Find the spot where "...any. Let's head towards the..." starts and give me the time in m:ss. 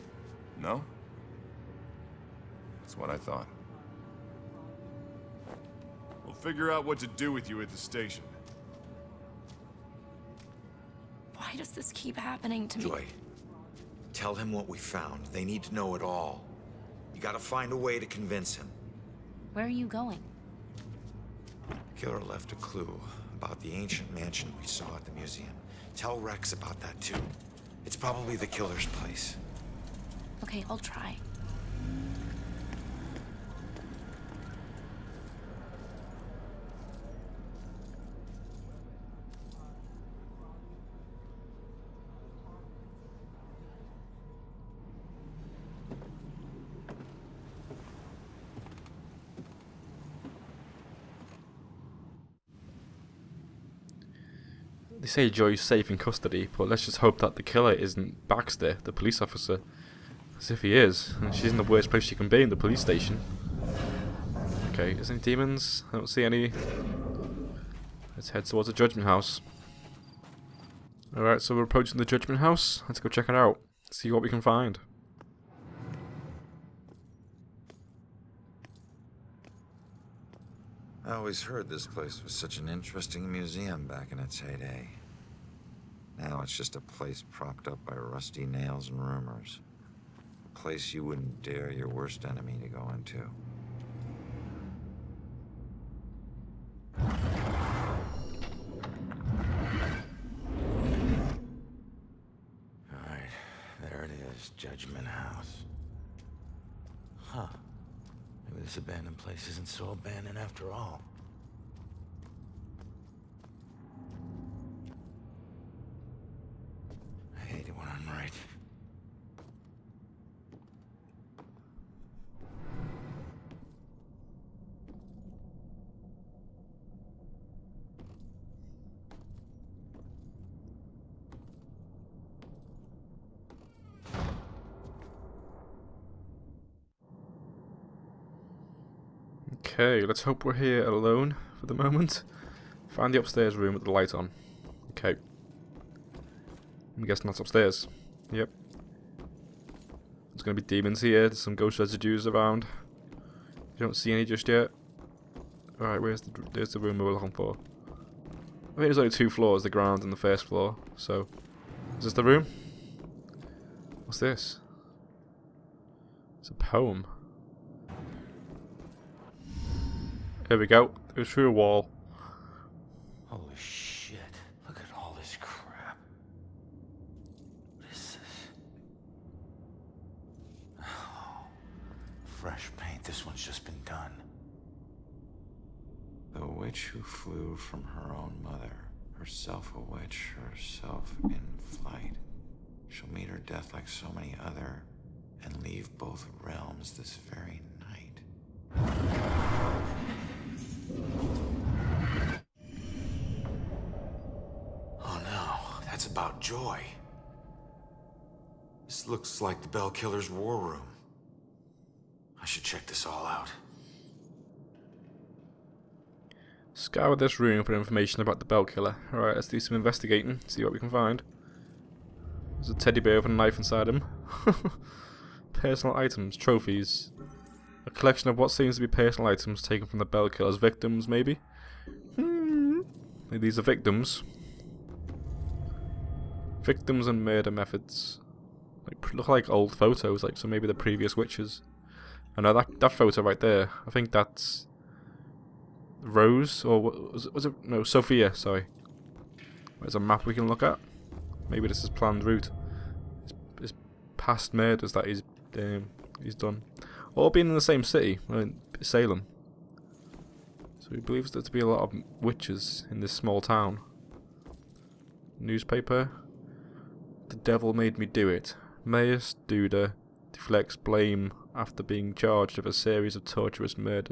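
1:06.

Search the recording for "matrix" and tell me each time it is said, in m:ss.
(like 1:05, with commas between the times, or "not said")
not said.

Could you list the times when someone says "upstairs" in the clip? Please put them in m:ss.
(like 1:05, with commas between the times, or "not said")
2:23, 2:27.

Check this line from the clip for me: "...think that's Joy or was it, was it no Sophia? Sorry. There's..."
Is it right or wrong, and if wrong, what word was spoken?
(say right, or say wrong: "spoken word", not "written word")
wrong: "Rose", not "Joy".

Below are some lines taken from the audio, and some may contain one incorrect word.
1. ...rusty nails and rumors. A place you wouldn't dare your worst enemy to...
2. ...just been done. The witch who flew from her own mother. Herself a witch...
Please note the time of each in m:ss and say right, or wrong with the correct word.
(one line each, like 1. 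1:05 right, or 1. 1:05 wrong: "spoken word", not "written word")
1. 1:27 right
2. 3:03 right.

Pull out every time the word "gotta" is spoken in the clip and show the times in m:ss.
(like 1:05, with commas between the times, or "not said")
0:17.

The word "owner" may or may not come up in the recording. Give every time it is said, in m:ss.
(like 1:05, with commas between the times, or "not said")
not said.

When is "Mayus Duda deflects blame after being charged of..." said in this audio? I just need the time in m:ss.
4:28.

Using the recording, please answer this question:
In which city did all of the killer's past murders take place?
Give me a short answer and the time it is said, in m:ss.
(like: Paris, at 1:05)
Salem, at 4:18.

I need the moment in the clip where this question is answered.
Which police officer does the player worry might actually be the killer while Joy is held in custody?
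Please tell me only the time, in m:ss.
0:58.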